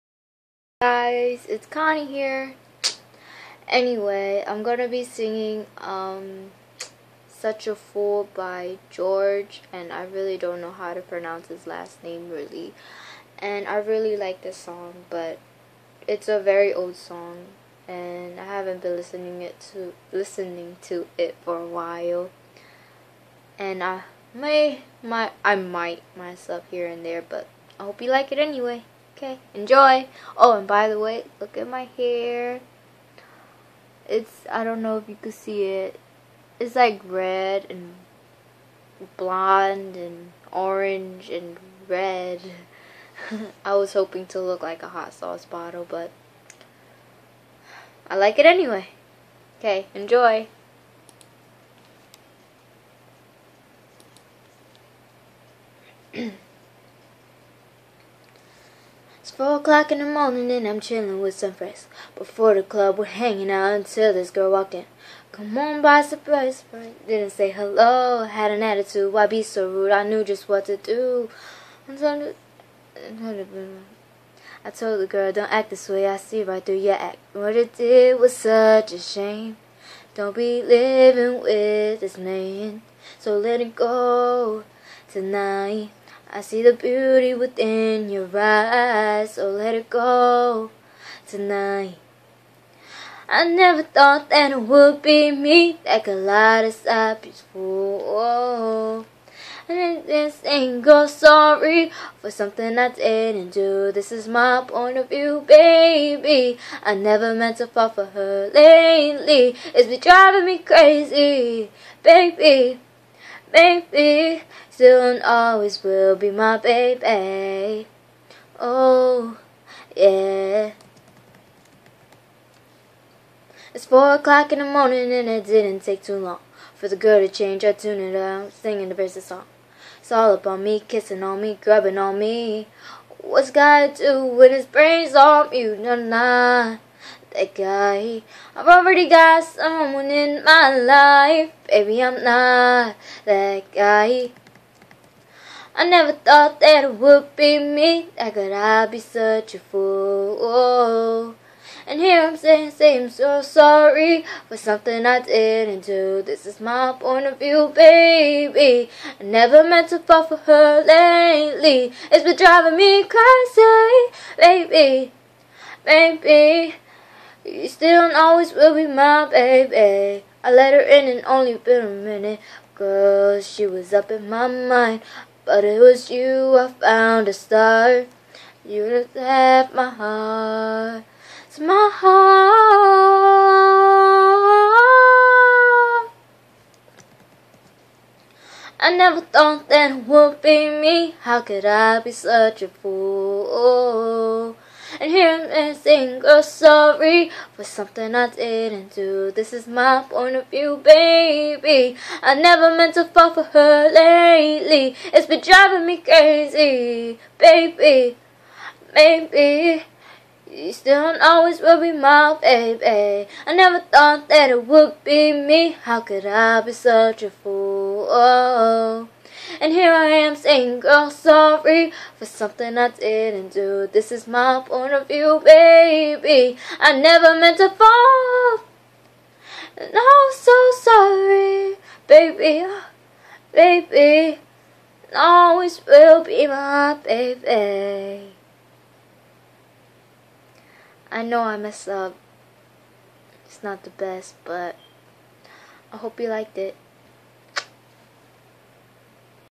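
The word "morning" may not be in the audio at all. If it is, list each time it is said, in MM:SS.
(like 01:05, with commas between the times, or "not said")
01:00, 02:04.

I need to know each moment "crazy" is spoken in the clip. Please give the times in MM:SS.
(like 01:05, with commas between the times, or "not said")
01:50, 02:43, 03:25.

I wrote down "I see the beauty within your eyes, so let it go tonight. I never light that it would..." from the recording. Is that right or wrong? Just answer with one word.
wrong.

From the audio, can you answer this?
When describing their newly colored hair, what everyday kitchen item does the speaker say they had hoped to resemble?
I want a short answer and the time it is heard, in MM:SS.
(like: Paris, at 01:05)
A hot sauce bottle, at 00:44.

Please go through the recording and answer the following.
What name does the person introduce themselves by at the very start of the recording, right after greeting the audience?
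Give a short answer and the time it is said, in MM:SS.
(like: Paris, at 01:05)
Konnie, at 00:01.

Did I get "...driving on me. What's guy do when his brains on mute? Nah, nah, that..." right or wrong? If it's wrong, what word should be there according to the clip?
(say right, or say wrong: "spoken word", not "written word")
wrong: "grabbing", not "driving".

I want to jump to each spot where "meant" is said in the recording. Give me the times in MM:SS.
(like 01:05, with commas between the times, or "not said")
01:47, 02:39, 03:22, 03:47.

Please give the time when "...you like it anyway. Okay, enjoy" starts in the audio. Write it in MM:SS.
00:28.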